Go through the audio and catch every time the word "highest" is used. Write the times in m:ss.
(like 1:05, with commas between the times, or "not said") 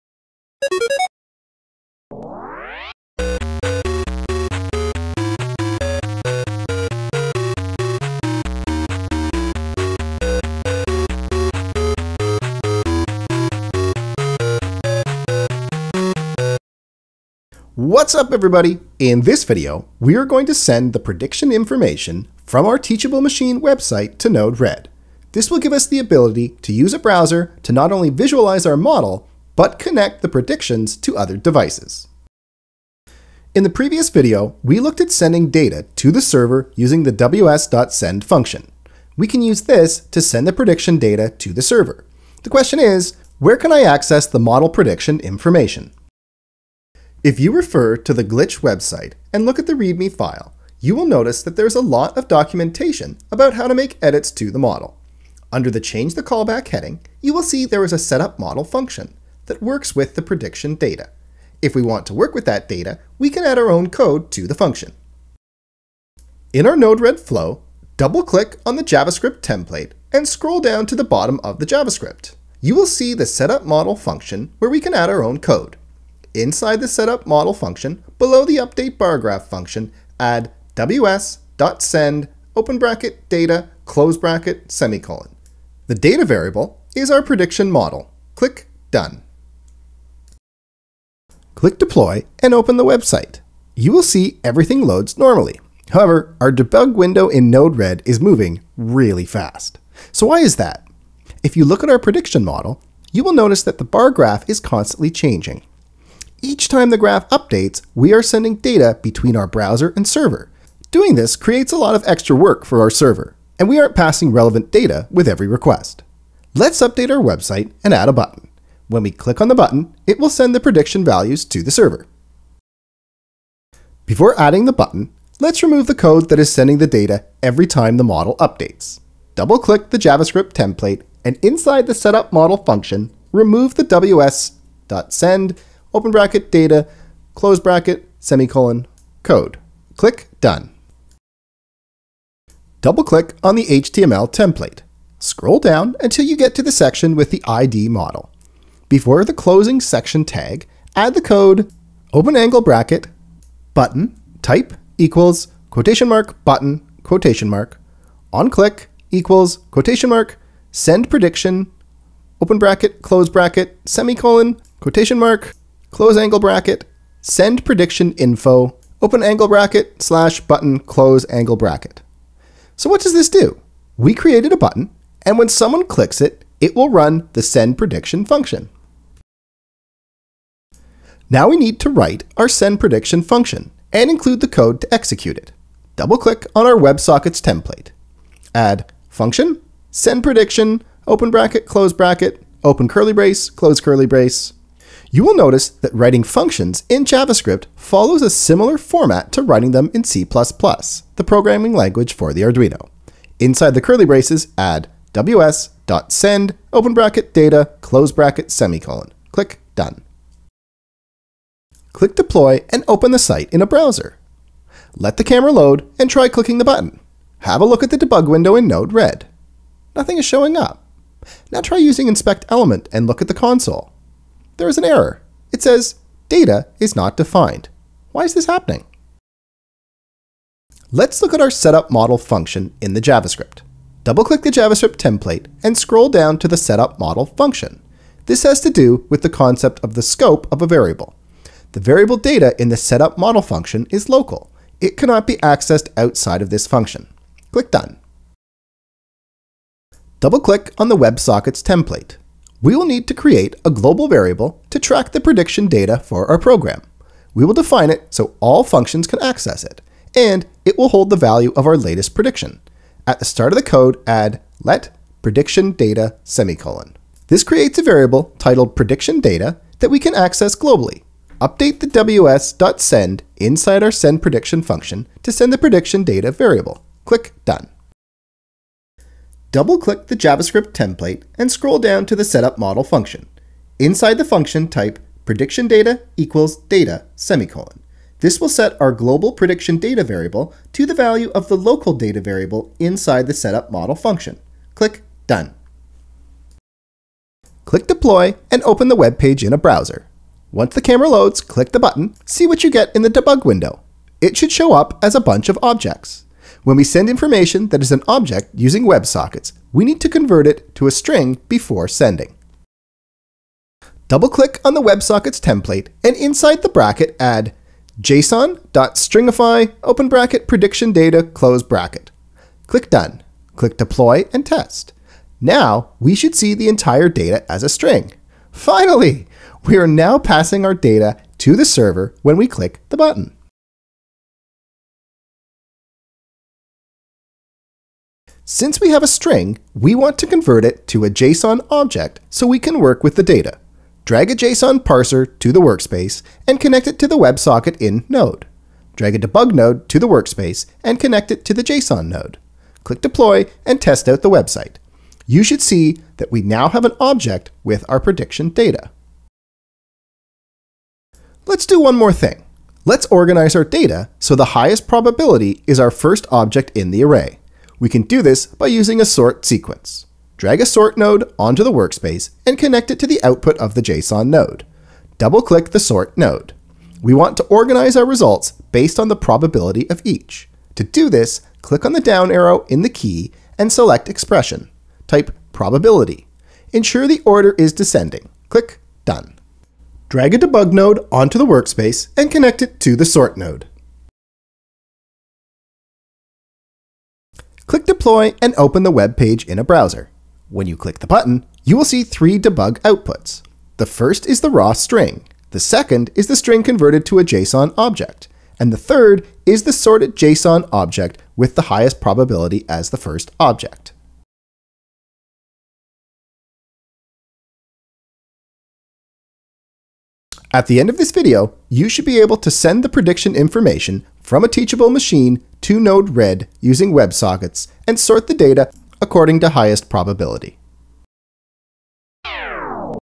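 6:04, 6:51, 7:09.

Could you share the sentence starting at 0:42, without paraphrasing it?
The question is, where can I access the model prediction information?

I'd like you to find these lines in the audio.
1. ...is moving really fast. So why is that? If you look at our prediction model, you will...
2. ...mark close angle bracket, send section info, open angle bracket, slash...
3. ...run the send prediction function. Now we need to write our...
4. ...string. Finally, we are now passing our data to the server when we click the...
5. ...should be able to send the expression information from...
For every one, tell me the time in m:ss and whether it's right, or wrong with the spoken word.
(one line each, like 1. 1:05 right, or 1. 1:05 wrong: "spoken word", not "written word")
1. 1:38 right
2. 2:45 wrong: "prediction", not "section"
3. 2:56 right
4. 5:27 right
5. 7:01 wrong: "prediction", not "expression".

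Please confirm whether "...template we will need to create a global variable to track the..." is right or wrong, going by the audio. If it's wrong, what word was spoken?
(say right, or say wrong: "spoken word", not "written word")
right.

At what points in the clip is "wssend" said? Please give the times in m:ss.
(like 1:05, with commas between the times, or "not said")
0:37, 1:20, 2:13, 3:25, 4:31.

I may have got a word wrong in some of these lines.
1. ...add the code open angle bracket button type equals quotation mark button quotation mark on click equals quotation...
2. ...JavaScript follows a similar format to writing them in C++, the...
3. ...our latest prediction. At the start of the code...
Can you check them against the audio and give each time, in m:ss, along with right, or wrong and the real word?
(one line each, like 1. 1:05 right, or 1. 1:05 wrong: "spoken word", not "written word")
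1. 2:30 right
2. 3:17 right
3. 4:21 right.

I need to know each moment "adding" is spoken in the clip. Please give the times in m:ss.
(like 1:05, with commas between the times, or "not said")
2:04.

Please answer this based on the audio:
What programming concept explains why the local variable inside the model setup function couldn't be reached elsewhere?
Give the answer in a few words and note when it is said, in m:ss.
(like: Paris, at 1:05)
scope of a variable, at 4:00.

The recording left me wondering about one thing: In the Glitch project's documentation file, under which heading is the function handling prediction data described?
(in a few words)
Change the Callback.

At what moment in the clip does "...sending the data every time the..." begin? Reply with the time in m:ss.
2:06.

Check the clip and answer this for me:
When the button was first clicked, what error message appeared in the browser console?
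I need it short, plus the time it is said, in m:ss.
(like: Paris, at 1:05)
data is not defined, at 3:46.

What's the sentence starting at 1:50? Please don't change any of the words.
Doing this creates a lot of extra work for our server, and we aren't passing relevant data with every request.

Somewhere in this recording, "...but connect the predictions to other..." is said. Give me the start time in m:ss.
0:29.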